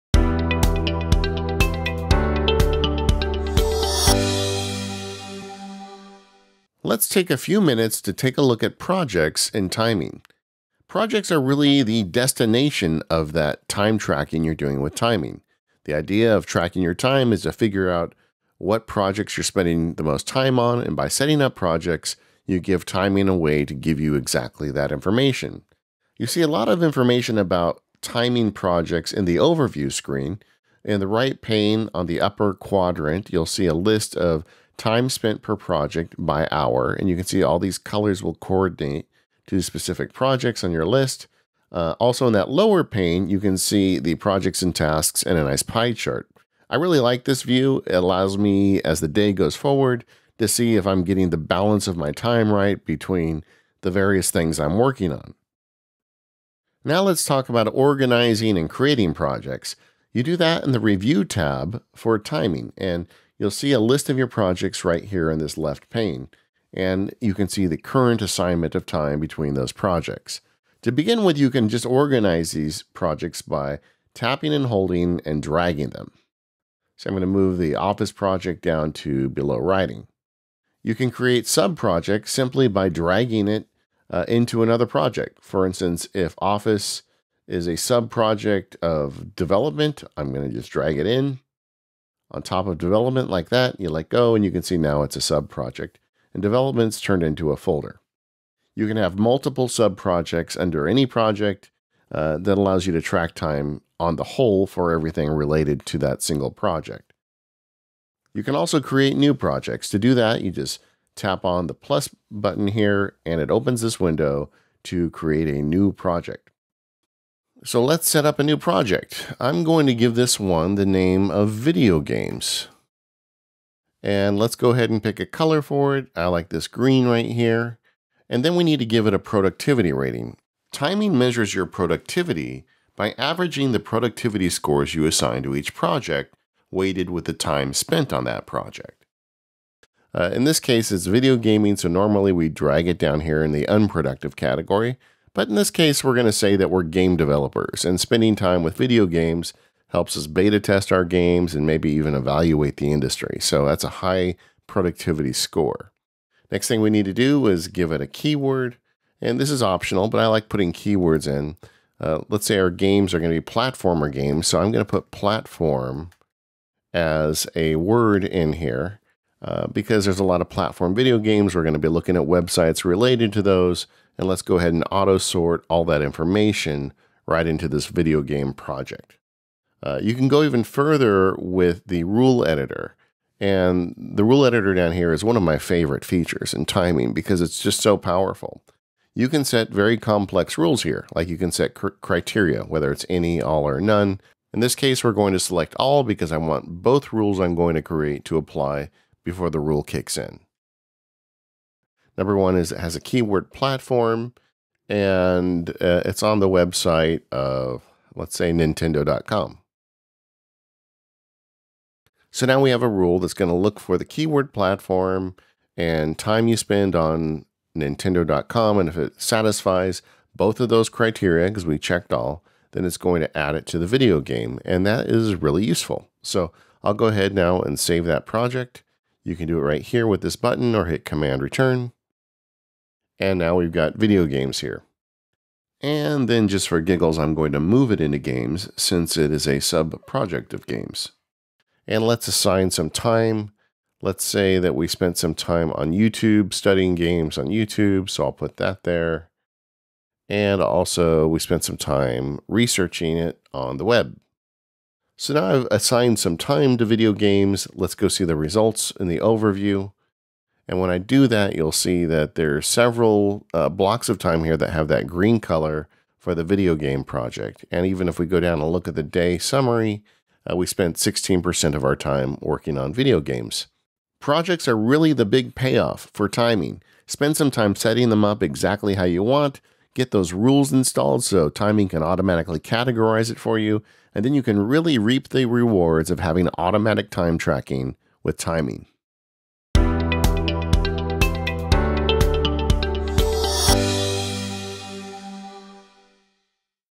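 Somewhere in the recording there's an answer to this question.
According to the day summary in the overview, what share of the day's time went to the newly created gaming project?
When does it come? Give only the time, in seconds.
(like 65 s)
270 s.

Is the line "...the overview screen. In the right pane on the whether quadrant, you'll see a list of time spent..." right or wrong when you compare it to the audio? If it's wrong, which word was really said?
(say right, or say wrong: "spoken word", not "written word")
wrong: "upper", not "whether".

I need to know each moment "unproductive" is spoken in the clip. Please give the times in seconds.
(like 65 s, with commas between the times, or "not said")
143 s.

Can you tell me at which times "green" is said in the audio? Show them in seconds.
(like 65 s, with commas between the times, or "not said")
126 s, 265 s.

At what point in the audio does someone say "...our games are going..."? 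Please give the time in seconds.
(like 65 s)
162 s.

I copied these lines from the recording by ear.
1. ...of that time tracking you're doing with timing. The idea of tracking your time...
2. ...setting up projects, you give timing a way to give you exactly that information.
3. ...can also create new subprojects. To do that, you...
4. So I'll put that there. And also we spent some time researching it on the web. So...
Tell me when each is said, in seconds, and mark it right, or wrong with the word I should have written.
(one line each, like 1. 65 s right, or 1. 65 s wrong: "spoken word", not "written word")
1. 13 s right
2. 21 s right
3. 108 s wrong: "projects", not "subprojects"
4. 248 s right.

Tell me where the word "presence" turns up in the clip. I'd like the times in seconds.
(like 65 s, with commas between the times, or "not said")
not said.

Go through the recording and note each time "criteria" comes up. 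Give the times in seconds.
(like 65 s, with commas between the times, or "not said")
192 s, 220 s.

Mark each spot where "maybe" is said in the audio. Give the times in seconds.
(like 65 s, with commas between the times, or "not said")
151 s.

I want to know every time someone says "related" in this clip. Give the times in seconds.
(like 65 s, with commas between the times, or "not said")
105 s, 172 s.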